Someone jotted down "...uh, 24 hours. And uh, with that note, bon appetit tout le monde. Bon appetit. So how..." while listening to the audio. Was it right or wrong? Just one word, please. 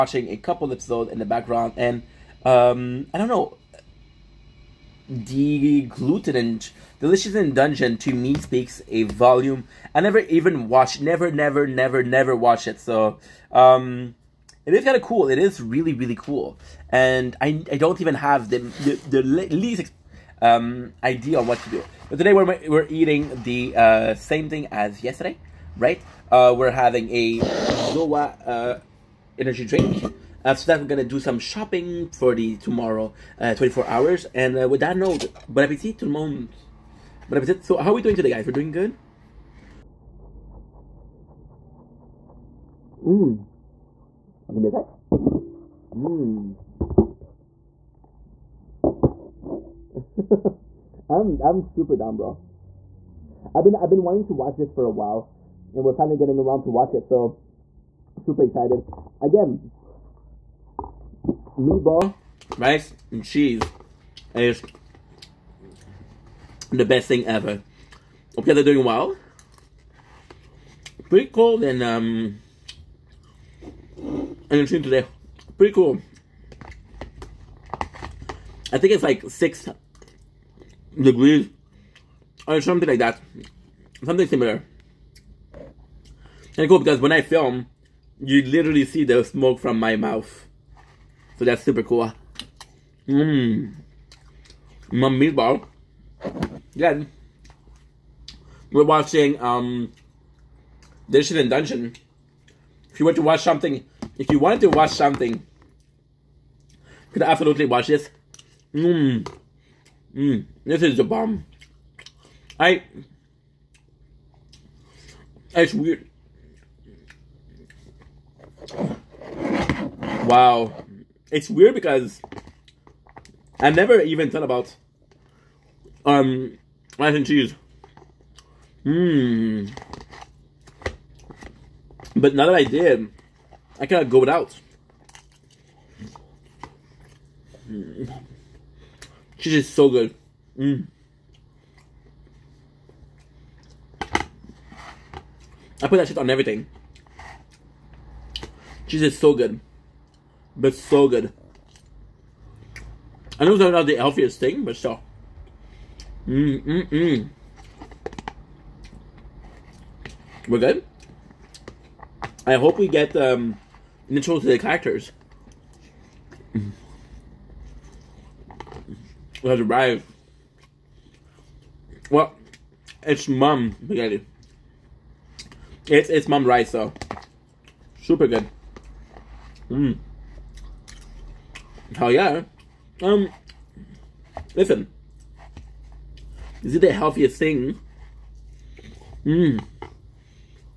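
right.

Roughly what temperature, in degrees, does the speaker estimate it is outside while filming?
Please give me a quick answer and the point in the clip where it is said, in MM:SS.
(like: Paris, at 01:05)
6 degrees, at 01:19.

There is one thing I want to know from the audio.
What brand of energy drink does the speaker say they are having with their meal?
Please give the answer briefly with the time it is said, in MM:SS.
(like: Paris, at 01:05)
Zoa, at 00:27.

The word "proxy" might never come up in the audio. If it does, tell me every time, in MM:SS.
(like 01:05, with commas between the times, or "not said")
not said.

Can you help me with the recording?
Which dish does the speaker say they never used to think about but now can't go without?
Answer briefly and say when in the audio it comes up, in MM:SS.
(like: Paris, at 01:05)
mac and cheese, at 02:06.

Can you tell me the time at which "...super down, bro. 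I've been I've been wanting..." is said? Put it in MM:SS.
00:51.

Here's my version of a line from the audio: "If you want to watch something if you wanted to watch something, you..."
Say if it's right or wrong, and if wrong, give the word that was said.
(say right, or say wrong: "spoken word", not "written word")
right.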